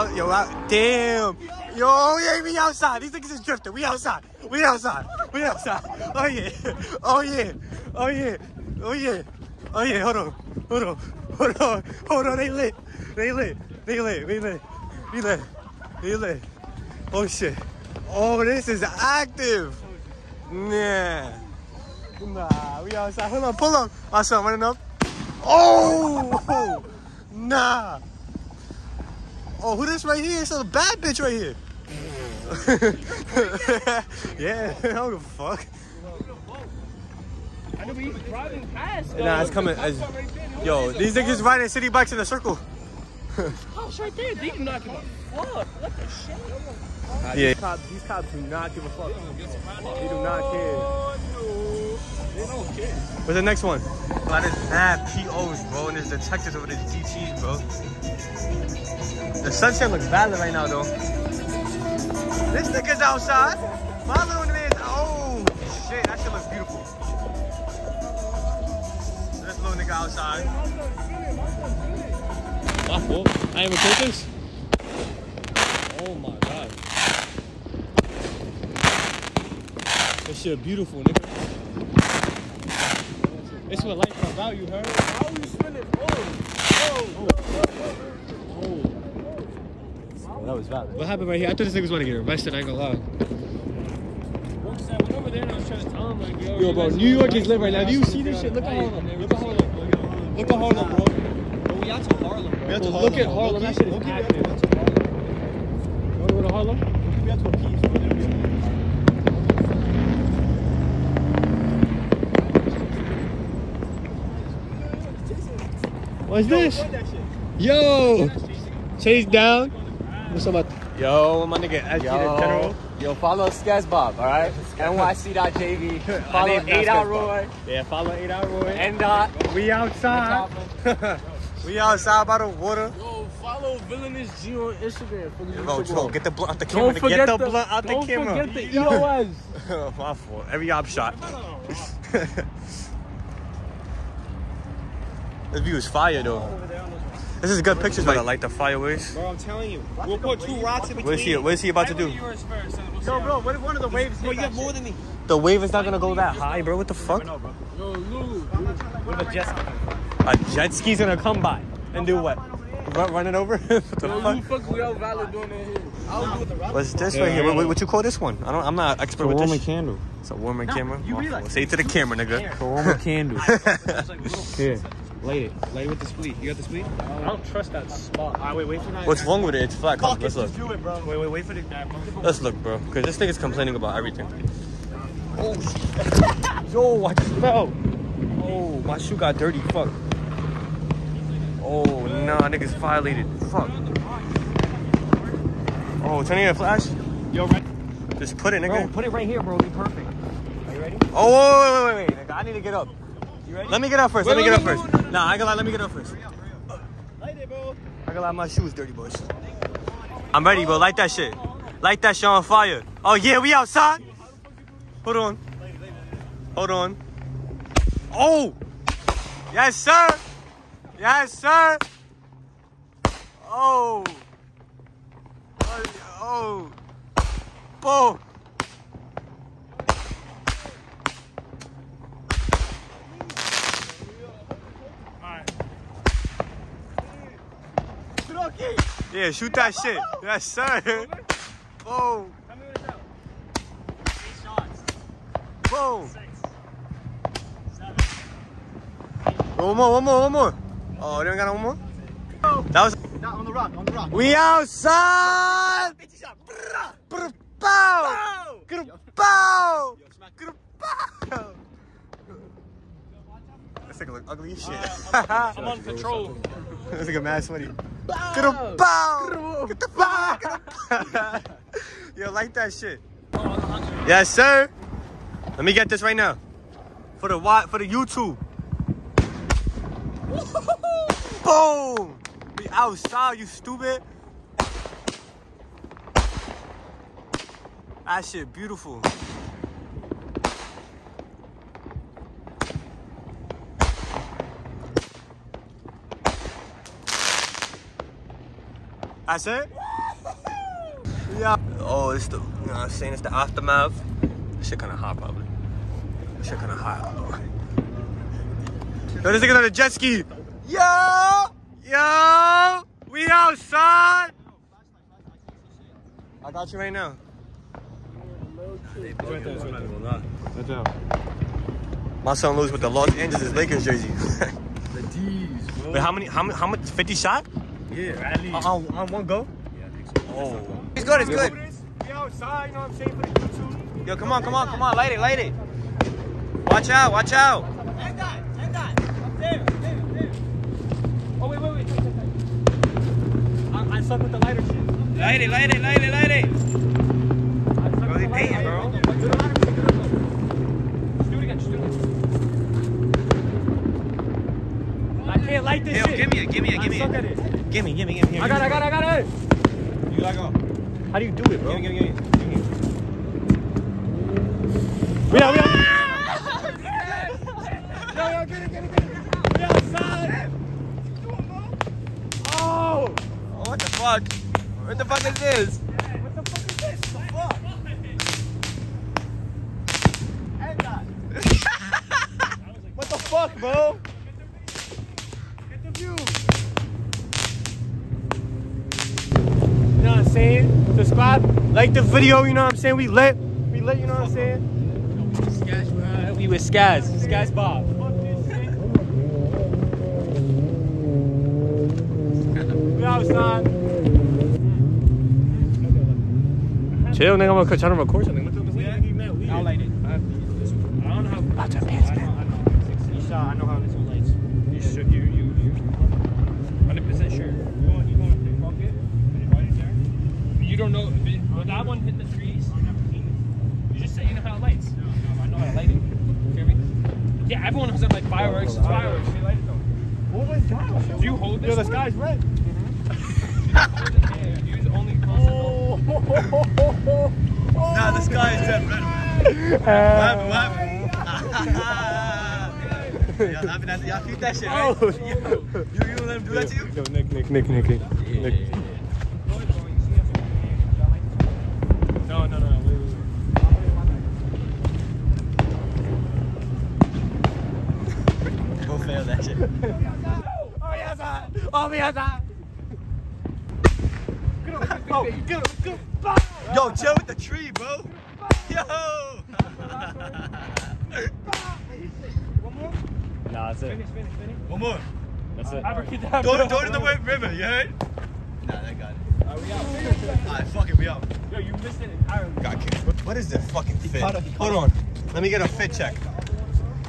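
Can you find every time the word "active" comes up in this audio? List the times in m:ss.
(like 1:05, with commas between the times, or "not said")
0:18, 1:44.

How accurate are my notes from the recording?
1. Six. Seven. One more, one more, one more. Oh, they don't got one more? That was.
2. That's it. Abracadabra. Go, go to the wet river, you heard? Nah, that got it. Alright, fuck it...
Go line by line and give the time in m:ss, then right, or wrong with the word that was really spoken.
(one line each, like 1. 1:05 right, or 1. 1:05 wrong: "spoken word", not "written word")
1. 4:06 right
2. 7:55 right.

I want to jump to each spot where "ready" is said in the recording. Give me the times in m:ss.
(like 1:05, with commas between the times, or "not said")
3:20, 3:30.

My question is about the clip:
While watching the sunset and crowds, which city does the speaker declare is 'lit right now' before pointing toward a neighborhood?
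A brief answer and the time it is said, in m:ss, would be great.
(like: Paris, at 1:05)
New York, at 1:36.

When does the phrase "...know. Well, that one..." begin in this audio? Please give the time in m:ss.
7:00.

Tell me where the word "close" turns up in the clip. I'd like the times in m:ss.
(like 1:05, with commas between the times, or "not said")
7:15.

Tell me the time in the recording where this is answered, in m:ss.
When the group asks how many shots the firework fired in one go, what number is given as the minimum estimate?
5:26.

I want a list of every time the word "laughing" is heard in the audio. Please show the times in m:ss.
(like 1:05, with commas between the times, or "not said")
7:23.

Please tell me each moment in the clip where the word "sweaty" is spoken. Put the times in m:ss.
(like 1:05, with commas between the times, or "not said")
4:27.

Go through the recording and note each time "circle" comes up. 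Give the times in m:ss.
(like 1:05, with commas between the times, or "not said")
0:42.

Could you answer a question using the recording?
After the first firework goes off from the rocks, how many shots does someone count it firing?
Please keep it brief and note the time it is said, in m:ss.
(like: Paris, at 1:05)
8, at 4:02.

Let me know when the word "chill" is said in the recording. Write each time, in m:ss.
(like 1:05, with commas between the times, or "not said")
6:47, 7:46.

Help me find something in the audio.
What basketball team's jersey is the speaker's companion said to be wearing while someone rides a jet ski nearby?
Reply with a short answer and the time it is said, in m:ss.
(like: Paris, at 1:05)
Los Angeles Lakers, at 5:22.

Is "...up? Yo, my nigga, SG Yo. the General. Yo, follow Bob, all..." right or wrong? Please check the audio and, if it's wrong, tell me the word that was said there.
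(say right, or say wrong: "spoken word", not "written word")
wrong: "Sketchbob", not "Bob".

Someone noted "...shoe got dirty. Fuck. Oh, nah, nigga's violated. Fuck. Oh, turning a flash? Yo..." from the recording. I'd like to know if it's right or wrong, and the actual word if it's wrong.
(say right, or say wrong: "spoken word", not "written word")
right.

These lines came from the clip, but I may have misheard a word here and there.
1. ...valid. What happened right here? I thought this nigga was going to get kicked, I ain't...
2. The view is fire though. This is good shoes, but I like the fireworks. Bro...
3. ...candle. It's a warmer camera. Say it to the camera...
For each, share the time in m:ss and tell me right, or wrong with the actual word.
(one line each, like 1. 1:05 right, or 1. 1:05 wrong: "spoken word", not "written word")
1. 1:30 wrong: "arrested", not "kicked"
2. 2:25 wrong: "pictures", not "shoes"
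3. 2:49 right.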